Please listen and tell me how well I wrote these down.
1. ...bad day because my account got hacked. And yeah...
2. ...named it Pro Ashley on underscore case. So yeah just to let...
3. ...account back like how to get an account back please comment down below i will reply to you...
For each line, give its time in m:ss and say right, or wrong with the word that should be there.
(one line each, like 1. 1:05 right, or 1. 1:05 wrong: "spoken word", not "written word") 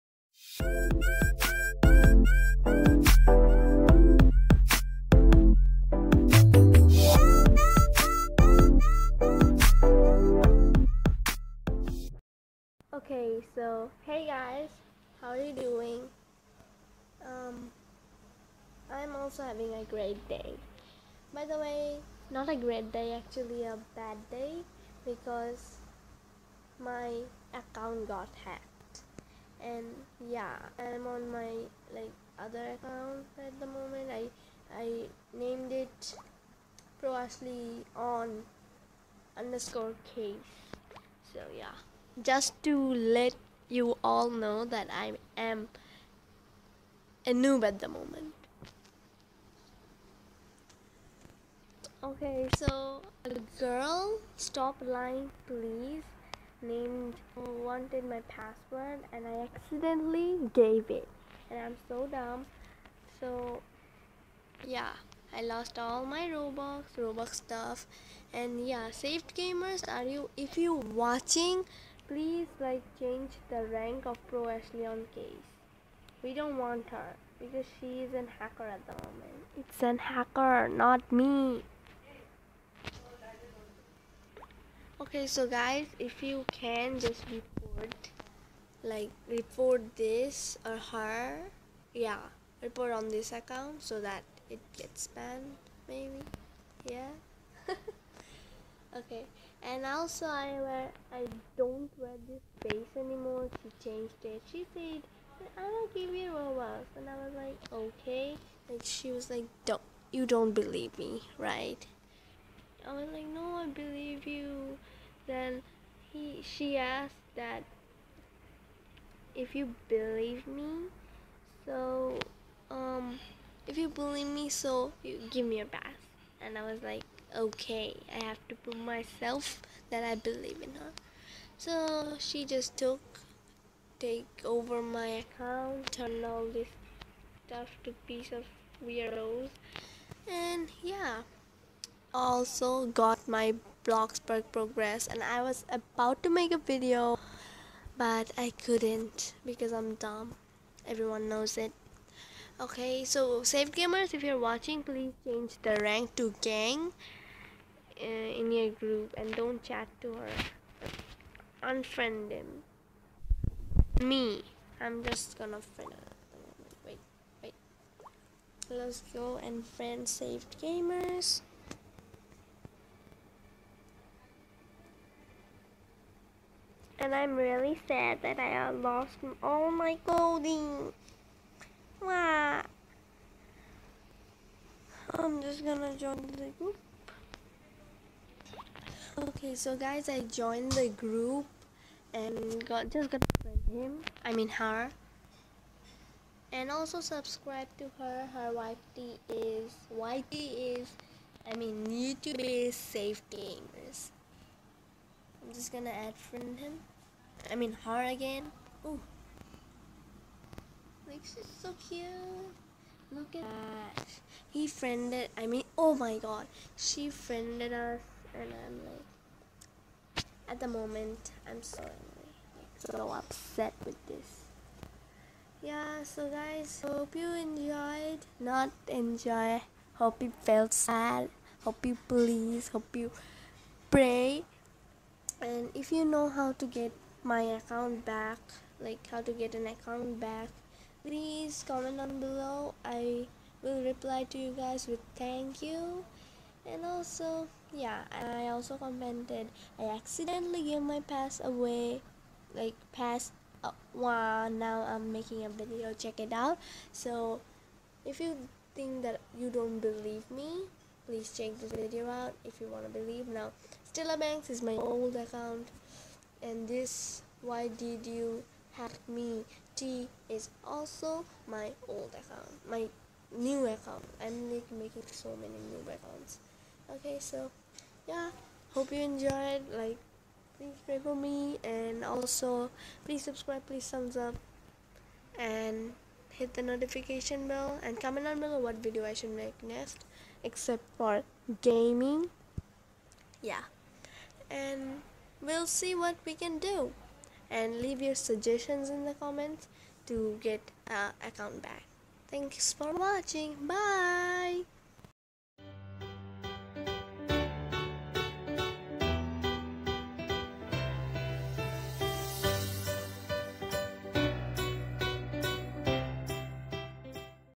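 1. 0:23 right
2. 0:35 right
3. 3:57 right.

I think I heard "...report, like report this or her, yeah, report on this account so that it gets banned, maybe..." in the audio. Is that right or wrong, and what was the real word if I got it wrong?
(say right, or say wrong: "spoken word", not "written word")
right.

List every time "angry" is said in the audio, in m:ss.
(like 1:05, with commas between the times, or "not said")
3:41.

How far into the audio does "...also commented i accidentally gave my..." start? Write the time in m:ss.
4:08.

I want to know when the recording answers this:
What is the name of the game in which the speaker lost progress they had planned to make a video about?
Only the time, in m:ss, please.
2:23.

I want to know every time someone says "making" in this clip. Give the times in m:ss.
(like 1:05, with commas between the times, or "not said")
4:15, 4:34.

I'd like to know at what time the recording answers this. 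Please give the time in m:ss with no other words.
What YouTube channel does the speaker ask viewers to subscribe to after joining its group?
3:22.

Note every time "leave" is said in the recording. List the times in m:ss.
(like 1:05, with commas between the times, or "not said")
4:57.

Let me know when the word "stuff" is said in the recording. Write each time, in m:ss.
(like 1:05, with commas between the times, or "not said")
1:07, 2:17.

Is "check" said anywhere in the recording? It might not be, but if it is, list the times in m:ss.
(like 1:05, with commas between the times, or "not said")
4:15, 4:21.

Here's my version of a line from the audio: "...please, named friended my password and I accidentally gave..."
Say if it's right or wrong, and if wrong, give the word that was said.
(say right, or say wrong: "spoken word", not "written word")
wrong: "wanted", not "friended".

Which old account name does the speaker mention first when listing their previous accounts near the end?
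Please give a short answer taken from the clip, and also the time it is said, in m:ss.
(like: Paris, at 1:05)
Stella Banks, at 4:23.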